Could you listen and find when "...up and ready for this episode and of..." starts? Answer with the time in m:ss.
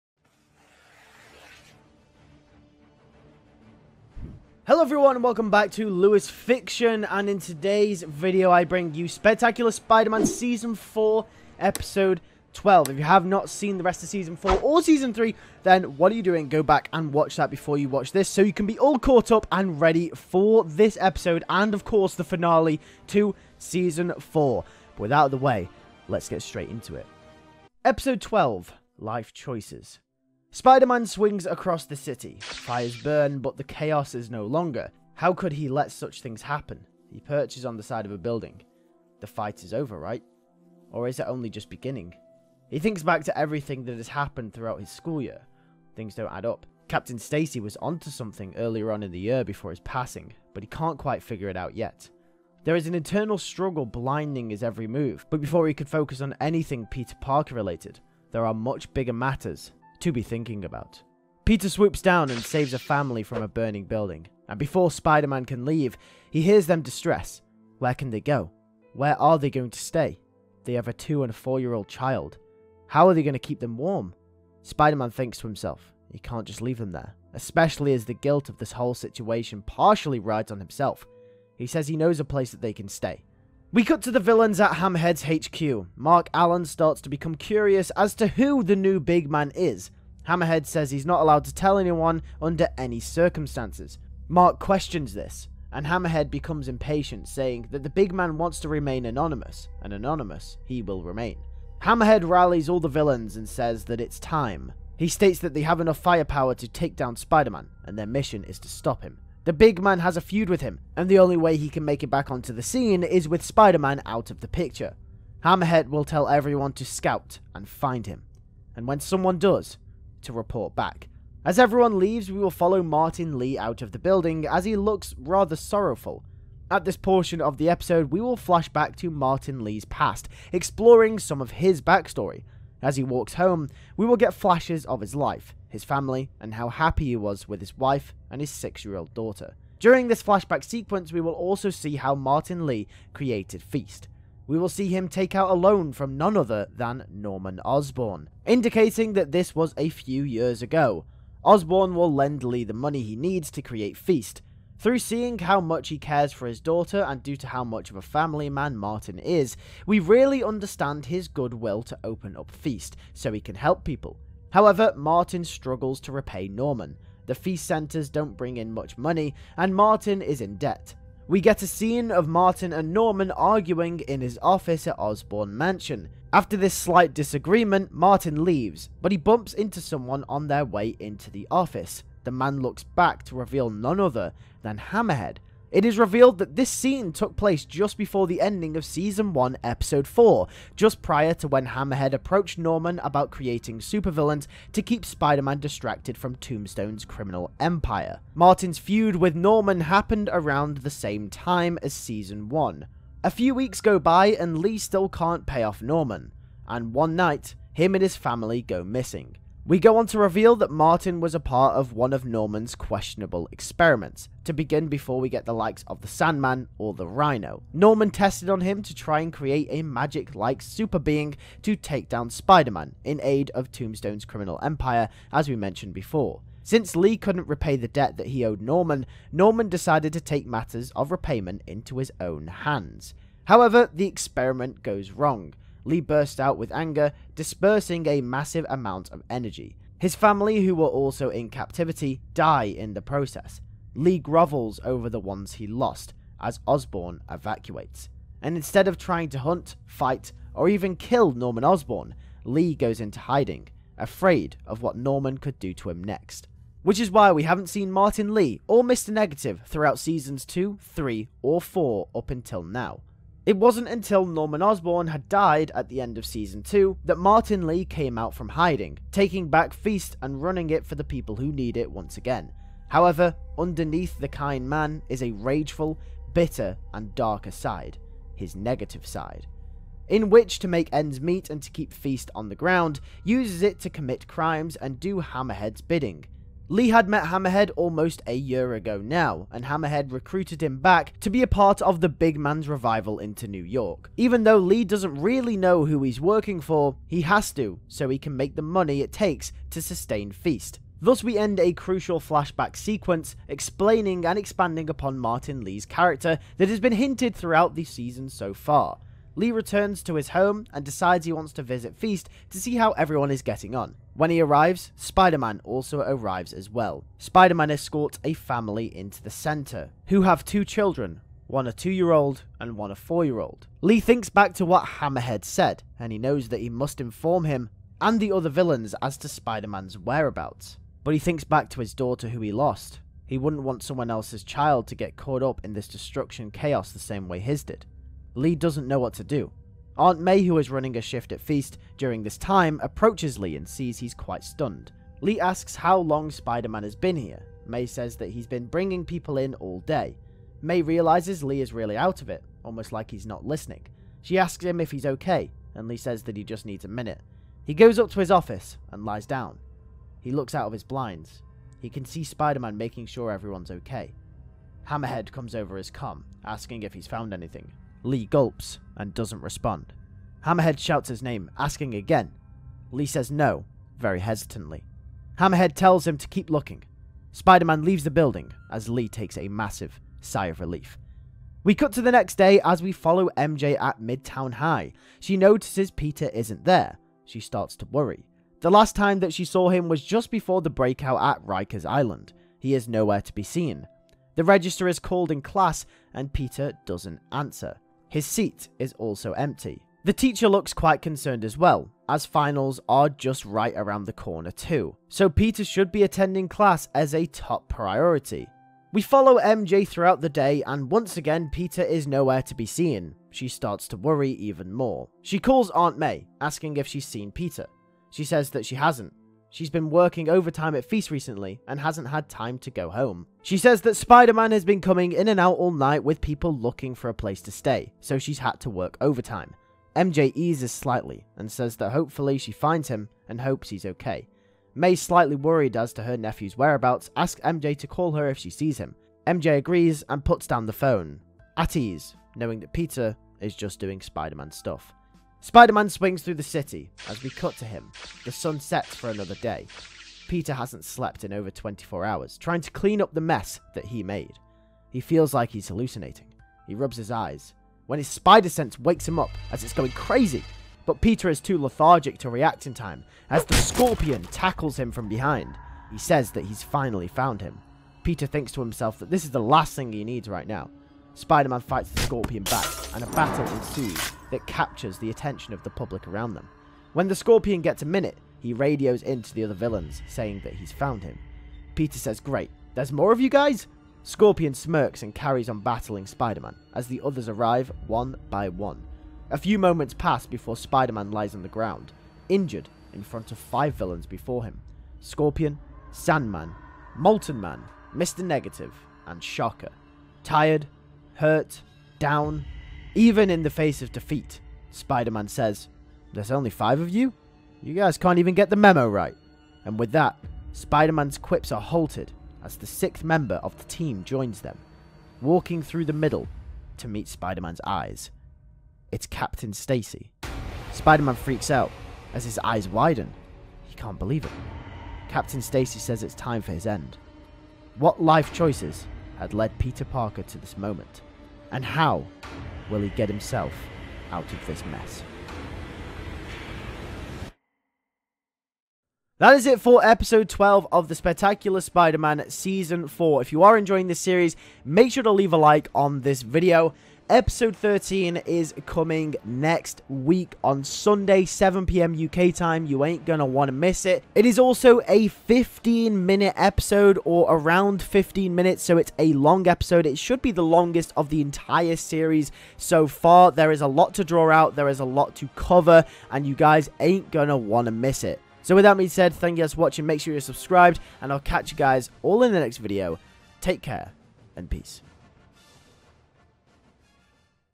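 0:19.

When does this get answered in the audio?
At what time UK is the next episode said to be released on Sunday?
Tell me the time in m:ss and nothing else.
9:11.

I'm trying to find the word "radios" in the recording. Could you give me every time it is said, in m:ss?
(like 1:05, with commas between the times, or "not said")
7:58.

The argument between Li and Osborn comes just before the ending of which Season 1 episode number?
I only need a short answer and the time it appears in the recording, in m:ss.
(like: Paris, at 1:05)
4, at 3:09.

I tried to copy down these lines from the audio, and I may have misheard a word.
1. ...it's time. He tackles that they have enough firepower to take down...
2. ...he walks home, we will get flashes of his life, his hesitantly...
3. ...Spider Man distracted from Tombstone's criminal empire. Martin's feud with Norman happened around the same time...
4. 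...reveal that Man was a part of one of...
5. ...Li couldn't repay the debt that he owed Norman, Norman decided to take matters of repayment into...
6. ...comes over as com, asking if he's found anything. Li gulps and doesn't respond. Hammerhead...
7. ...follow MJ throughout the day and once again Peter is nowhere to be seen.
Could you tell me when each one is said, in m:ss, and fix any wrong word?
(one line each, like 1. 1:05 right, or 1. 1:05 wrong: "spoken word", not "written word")
1. 1:44 wrong: "states", not "tackles"
2. 2:12 wrong: "family", not "hesitantly"
3. 3:15 right
4. 3:30 wrong: "Martin", not "Man"
5. 3:46 right
6. 6:05 right
7. 6:49 right.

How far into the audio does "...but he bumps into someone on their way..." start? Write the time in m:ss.
2:59.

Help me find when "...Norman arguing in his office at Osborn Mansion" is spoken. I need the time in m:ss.
2:52.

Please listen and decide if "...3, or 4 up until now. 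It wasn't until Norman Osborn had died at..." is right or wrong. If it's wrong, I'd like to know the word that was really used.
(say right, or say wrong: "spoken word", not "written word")
right.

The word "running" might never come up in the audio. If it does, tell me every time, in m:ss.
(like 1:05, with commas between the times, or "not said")
4:30, 5:40.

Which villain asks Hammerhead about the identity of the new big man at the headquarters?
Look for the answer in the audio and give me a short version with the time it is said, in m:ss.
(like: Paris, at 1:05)
Mark Allen, at 1:25.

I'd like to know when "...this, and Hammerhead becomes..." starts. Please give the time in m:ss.
1:35.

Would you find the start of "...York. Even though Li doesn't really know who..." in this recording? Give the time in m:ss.
4:53.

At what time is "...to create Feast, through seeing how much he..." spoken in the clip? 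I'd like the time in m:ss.
2:33.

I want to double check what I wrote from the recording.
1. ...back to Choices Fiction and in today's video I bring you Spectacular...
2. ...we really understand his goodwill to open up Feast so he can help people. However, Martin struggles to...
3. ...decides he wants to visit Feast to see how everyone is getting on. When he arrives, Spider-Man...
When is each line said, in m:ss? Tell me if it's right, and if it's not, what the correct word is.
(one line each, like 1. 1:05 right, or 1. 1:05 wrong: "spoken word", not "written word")
1. 0:05 wrong: "Lewis", not "Choices"
2. 2:39 right
3. 5:10 right.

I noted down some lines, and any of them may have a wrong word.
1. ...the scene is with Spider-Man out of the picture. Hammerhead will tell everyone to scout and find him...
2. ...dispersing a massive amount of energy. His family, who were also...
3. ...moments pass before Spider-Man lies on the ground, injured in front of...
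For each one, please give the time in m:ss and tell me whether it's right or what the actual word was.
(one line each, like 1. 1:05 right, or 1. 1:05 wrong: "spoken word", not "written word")
1. 1:52 right
2. 3:57 right
3. 8:09 right.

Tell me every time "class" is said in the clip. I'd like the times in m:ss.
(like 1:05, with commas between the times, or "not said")
6:35, 6:46.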